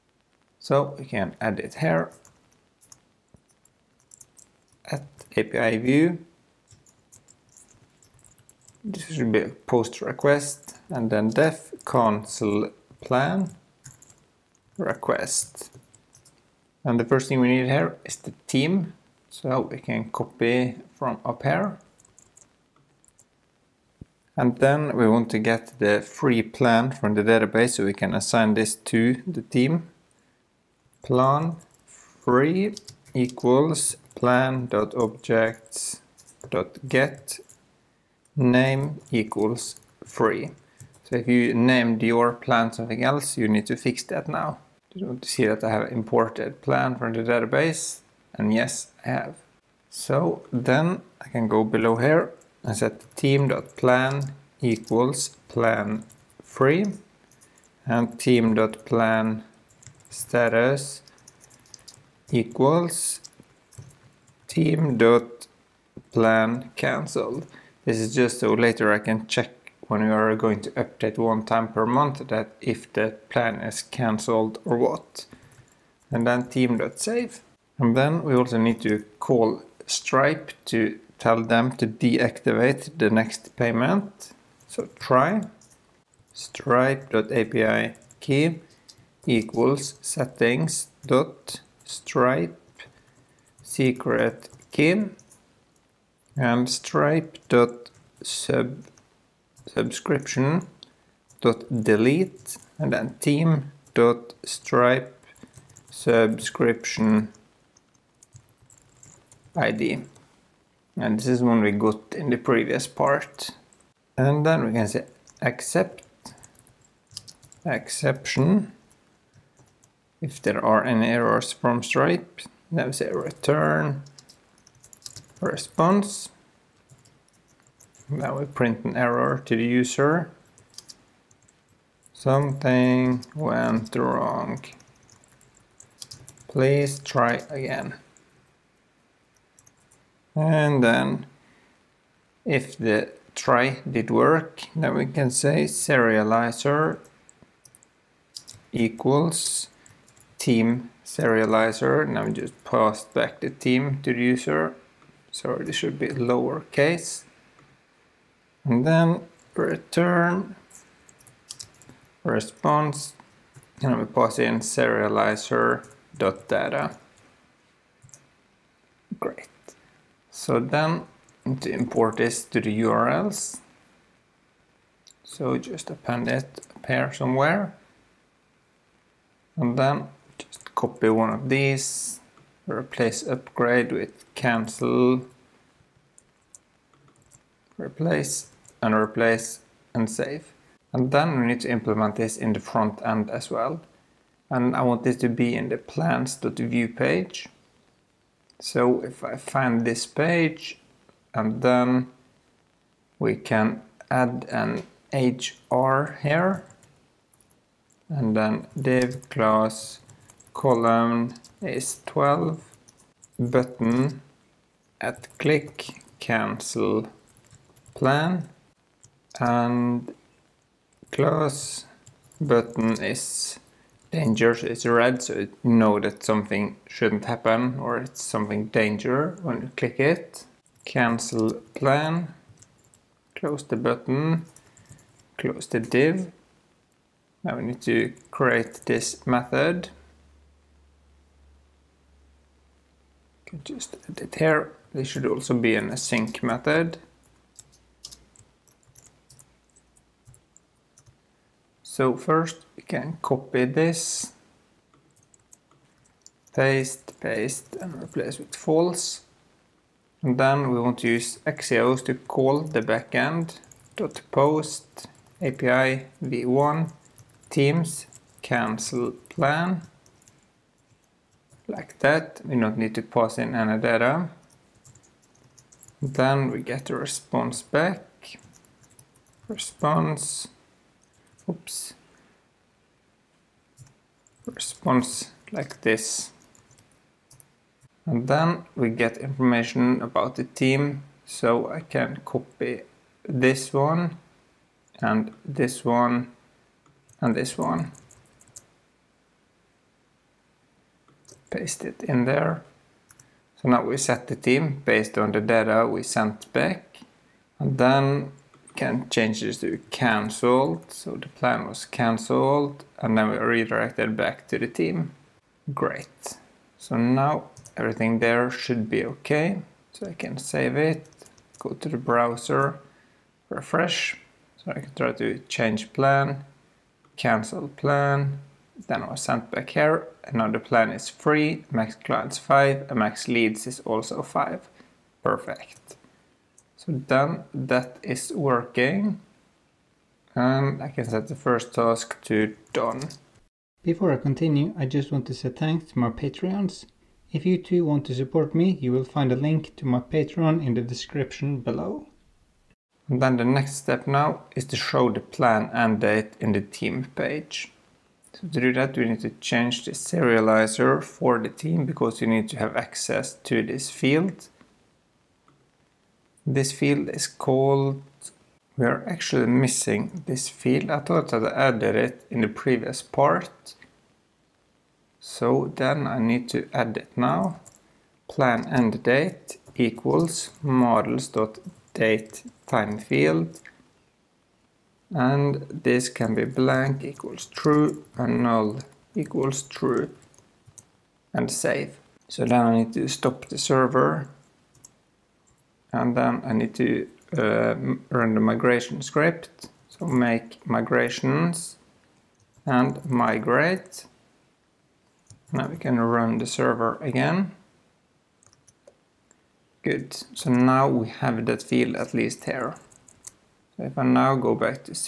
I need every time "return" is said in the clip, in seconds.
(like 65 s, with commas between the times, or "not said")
123 s, 159 s.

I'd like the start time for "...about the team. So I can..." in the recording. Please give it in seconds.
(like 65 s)
290 s.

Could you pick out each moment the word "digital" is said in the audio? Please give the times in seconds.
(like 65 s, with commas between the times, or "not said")
not said.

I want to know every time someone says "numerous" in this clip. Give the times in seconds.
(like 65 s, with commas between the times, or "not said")
not said.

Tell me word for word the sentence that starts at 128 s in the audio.
Now we print an error to the user.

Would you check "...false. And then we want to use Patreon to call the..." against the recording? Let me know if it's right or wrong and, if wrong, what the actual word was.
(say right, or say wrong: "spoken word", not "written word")
wrong: "Axios", not "Patreon".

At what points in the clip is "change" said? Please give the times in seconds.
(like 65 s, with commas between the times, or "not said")
309 s, 325 s, 359 s.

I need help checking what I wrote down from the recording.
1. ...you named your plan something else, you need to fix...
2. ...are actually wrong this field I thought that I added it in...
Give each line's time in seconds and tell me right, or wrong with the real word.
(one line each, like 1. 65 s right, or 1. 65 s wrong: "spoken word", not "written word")
1. 41 s right
2. 368 s wrong: "missing", not "wrong".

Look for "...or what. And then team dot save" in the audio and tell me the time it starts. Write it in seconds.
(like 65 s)
74 s.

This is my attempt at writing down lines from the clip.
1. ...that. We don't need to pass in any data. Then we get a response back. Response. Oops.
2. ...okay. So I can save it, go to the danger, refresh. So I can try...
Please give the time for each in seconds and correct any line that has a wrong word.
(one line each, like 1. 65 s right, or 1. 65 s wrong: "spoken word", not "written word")
1. 271 s right
2. 319 s wrong: "browser", not "danger".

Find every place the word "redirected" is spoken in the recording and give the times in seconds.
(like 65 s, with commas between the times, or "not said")
313 s.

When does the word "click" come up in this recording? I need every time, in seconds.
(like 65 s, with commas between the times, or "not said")
215 s, 229 s.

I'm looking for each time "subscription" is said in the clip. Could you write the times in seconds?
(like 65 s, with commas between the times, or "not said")
99 s, 105 s.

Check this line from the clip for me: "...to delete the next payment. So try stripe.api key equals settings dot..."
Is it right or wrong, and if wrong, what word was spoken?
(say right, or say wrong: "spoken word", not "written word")
wrong: "deactivate", not "delete".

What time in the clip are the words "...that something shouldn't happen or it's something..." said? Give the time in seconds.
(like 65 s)
225 s.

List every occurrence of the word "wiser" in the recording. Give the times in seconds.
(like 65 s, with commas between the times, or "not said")
not said.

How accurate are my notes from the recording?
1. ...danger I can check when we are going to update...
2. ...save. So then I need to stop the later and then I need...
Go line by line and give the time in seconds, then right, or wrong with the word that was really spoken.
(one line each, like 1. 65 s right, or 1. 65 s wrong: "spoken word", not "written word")
1. 68 s wrong: "later", not "danger"
2. 391 s wrong: "server", not "later".